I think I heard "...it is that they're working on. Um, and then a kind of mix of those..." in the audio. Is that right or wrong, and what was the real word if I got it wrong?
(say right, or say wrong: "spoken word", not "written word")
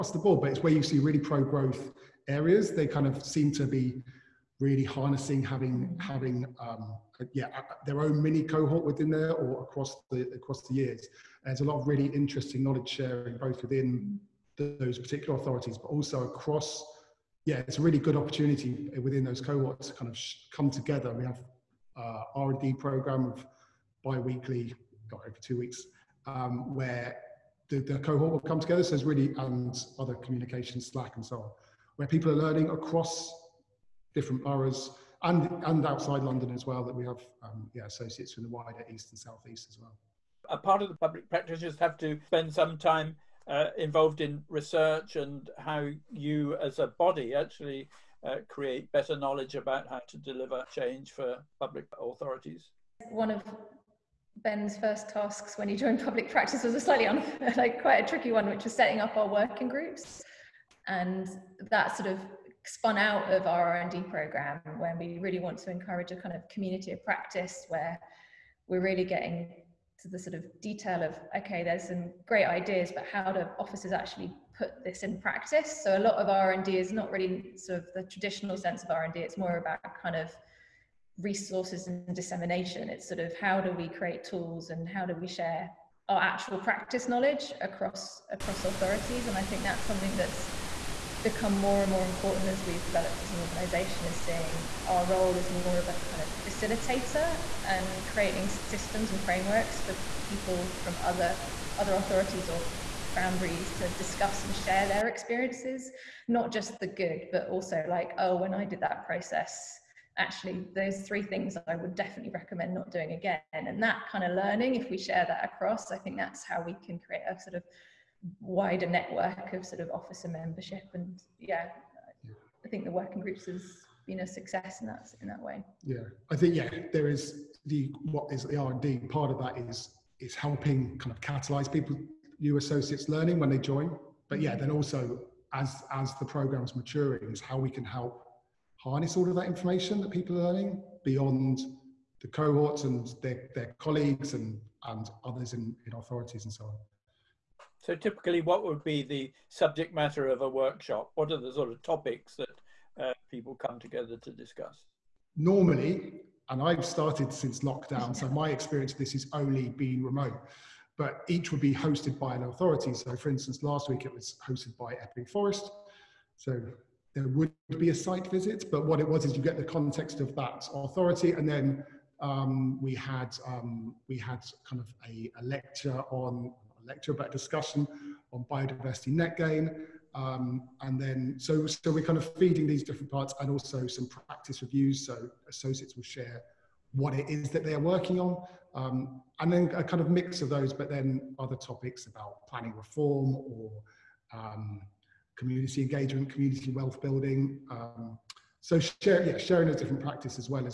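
right.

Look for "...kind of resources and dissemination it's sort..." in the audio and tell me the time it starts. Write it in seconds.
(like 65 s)
80 s.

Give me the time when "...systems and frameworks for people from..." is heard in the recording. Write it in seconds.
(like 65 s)
98 s.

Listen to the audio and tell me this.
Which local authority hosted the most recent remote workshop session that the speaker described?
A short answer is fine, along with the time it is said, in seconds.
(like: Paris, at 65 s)
Epping Forest, at 165 s.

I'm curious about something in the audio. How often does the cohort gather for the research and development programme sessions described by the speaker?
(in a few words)
Every two weeks.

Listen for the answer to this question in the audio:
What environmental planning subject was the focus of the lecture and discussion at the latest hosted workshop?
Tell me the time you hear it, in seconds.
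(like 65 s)
178 s.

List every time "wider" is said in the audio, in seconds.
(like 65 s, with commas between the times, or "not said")
38 s, 118 s.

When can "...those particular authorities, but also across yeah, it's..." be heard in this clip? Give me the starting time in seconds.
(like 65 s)
14 s.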